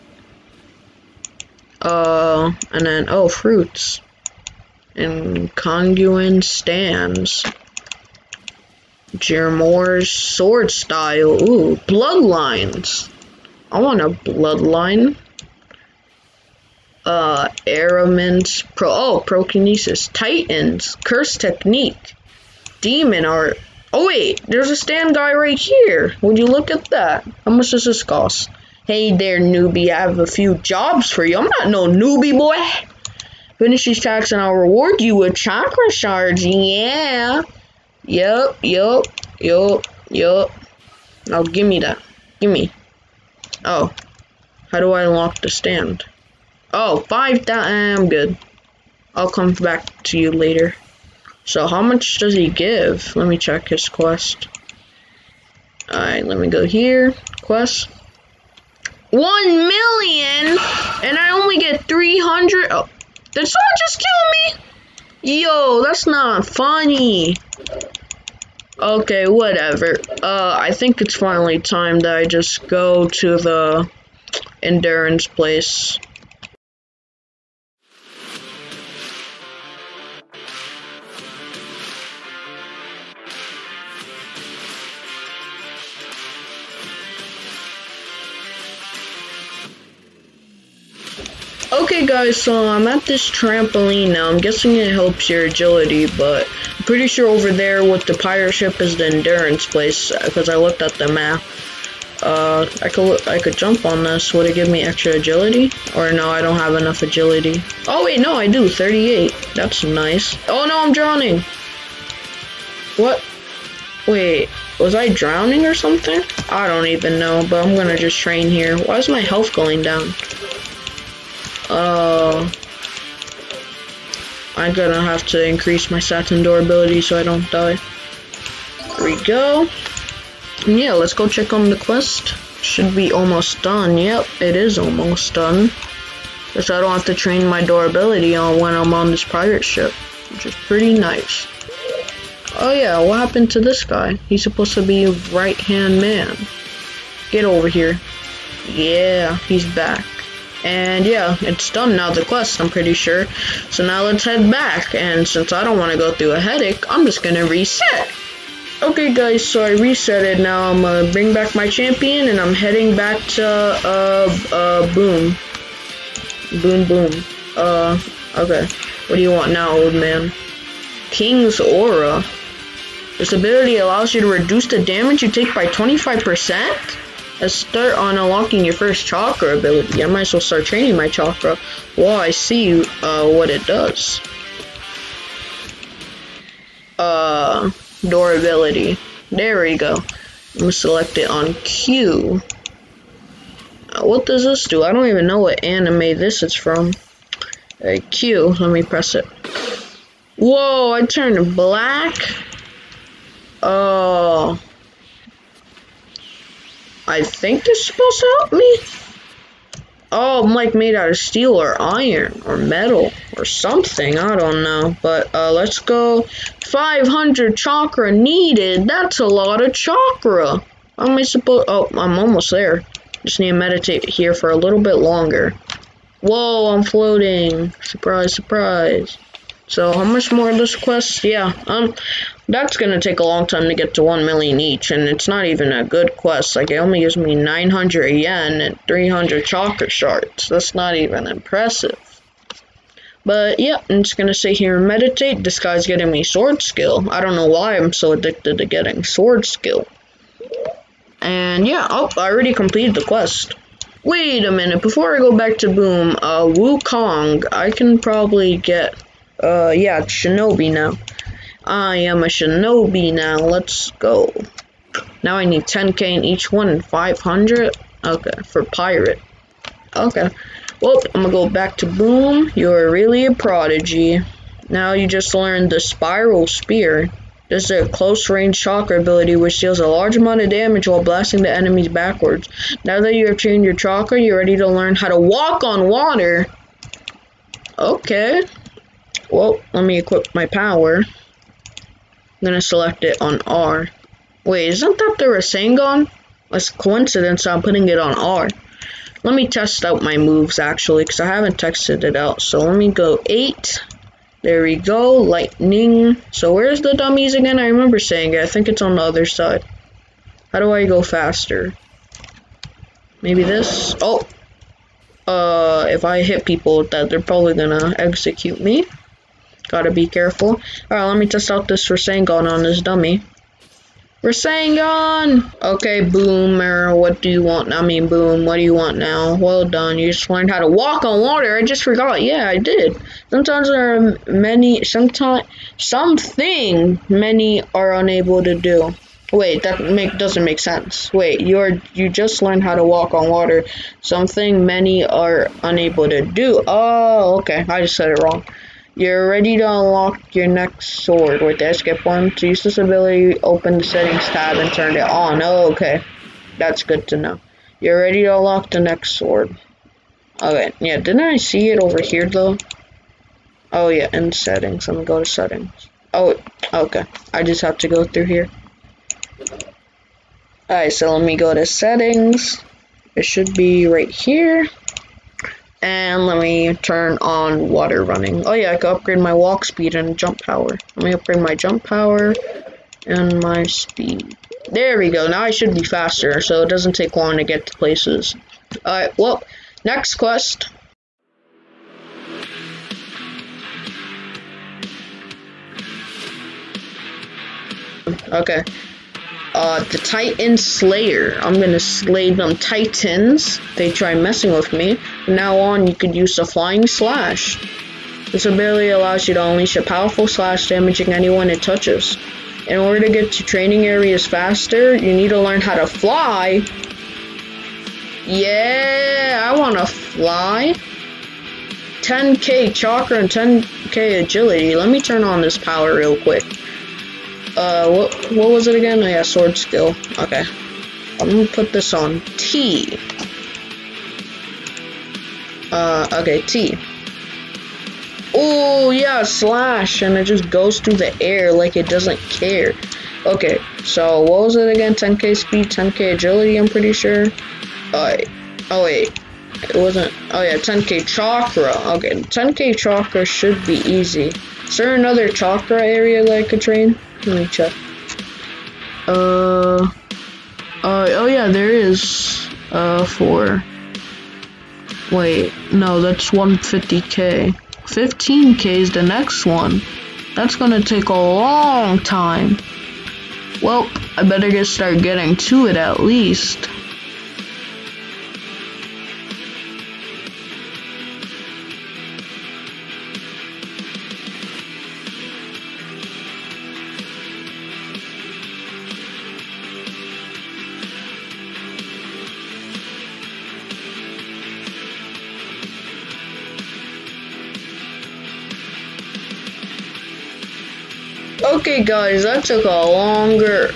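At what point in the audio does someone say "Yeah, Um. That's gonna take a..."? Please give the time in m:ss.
3:51.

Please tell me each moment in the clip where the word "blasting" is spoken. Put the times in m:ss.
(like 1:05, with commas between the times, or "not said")
4:41.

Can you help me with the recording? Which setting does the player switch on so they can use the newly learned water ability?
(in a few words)
Water running.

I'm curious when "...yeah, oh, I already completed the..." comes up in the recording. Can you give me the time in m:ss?
4:11.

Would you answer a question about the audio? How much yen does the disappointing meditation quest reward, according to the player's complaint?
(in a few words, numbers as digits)
900 yen.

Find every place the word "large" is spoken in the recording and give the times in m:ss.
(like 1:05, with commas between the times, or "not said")
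4:39.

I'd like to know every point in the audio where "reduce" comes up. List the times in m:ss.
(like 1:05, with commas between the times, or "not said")
2:54.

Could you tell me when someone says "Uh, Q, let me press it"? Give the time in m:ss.
3:17.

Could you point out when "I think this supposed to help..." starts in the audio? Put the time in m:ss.
3:27.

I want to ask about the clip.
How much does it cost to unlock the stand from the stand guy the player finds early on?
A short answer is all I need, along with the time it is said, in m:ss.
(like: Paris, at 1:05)
5000, at 0:47.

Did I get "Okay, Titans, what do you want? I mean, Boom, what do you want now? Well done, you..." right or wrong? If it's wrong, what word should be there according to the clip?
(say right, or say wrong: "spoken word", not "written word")
wrong: "Boomer", not "Titans".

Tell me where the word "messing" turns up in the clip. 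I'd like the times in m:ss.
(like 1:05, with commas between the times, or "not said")
6:44.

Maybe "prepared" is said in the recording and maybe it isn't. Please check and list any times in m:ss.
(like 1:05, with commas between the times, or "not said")
not said.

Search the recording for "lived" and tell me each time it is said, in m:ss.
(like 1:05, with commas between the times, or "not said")
not said.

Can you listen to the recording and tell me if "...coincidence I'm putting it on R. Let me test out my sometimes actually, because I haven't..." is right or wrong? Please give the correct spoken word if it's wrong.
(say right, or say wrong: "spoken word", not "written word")
wrong: "moves", not "sometimes".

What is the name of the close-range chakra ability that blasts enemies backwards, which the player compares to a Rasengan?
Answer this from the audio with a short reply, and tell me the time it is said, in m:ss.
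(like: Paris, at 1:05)
Spiral Spear, at 4:35.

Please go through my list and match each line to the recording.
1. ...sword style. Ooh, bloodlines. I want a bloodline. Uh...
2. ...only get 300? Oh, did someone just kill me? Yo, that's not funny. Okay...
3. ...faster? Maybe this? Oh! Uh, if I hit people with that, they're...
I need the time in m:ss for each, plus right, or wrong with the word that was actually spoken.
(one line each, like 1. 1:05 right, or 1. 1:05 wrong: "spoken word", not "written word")
1. 0:10 right
2. 1:01 right
3. 5:11 right.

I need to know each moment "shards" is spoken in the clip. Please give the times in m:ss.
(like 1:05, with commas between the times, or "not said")
0:35, 3:59.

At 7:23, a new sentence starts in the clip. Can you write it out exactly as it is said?
Okay, so what was it again?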